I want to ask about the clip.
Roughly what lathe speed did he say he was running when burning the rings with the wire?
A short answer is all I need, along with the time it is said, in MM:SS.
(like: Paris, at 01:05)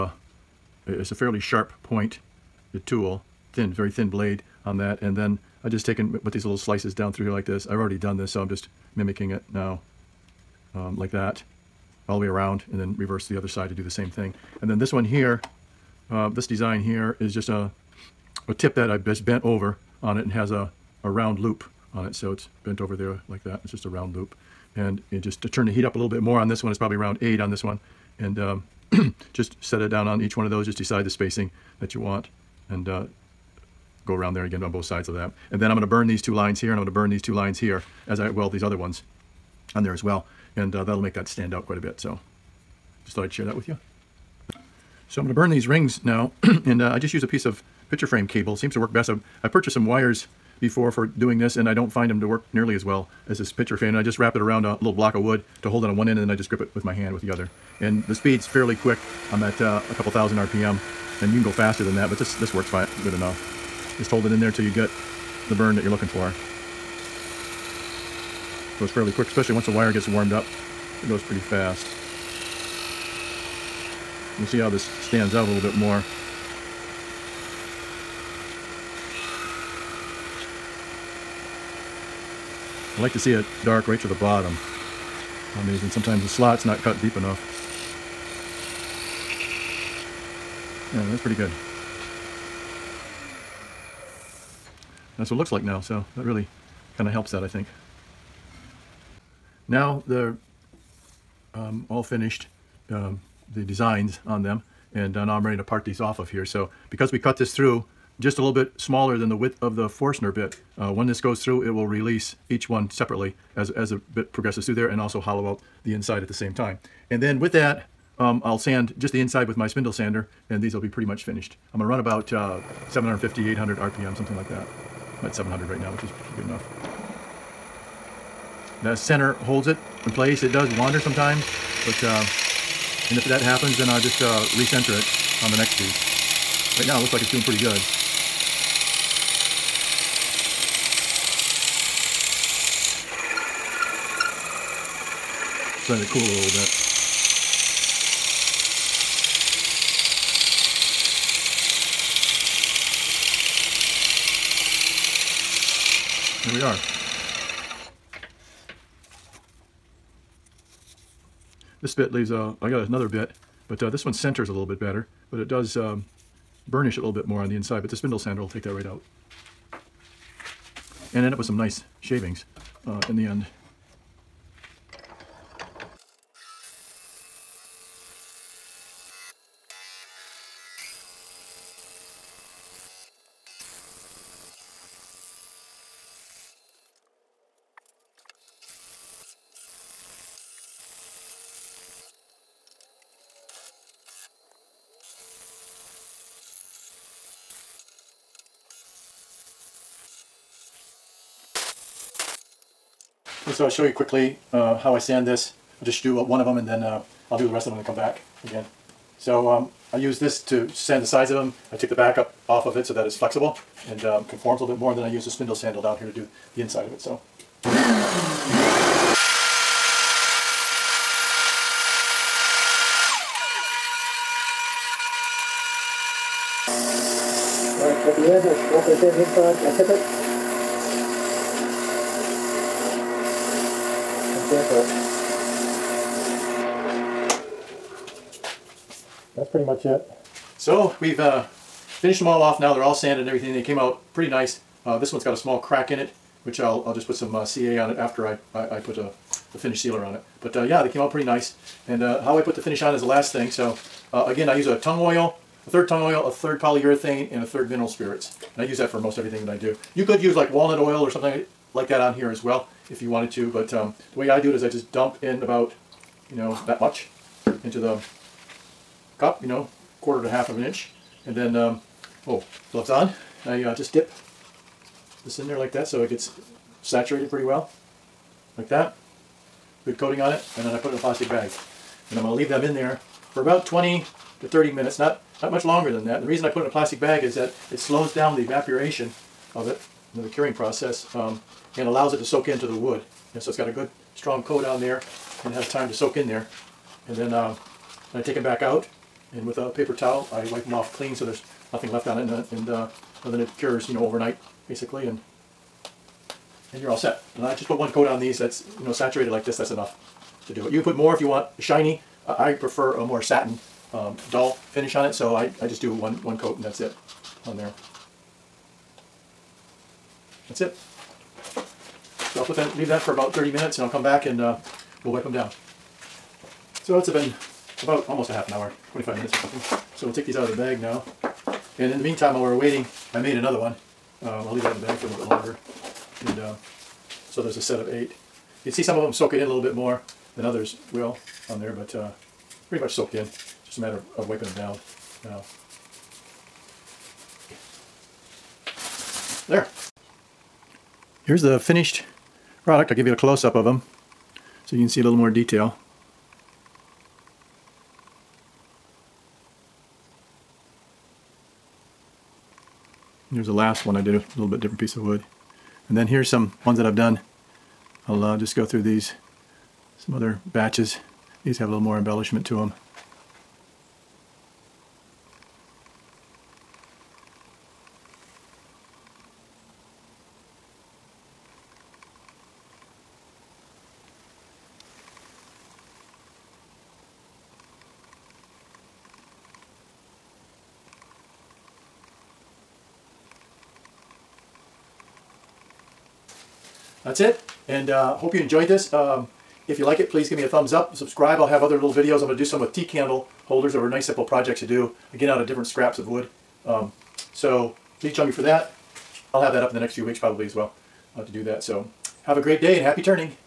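a couple thousand RPM, at 00:59.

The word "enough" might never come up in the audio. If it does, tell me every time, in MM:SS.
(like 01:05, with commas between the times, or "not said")
01:03, 01:27, 02:06, 05:09.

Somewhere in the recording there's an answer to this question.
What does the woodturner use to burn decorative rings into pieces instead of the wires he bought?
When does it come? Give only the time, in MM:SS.
00:47.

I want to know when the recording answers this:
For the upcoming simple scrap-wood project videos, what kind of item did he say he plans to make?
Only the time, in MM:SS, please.
06:42.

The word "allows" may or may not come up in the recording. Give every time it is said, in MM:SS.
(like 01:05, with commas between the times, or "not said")
04:51.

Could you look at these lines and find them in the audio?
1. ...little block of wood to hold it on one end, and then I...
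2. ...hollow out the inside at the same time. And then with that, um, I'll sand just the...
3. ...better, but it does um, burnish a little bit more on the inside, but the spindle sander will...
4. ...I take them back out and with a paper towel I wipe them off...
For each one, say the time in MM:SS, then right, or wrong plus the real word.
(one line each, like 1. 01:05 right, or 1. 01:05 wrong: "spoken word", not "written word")
1. 00:54 right
2. 01:55 right
3. 02:44 right
4. 04:58 right.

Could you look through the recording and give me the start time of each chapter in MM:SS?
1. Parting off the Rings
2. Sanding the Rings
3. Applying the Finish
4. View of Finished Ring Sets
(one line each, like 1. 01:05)
1. 01:42
2. 03:22
3. 03:59
4. 05:49.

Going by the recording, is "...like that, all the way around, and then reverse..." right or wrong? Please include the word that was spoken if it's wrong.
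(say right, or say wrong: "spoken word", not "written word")
right.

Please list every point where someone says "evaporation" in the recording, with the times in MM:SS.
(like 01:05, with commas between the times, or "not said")
04:48.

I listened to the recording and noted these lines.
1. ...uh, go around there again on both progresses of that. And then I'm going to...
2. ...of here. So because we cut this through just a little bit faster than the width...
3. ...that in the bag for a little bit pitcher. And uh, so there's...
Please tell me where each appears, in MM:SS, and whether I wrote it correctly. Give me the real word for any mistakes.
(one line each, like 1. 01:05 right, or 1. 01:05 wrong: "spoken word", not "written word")
1. 00:32 wrong: "sides", not "progresses"
2. 01:46 wrong: "smaller", not "faster"
3. 05:34 wrong: "longer", not "pitcher".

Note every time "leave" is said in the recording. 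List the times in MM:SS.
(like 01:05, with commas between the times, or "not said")
02:42, 04:42, 05:22, 05:34.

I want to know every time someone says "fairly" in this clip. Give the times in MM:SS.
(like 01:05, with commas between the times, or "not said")
00:01, 00:58, 01:08.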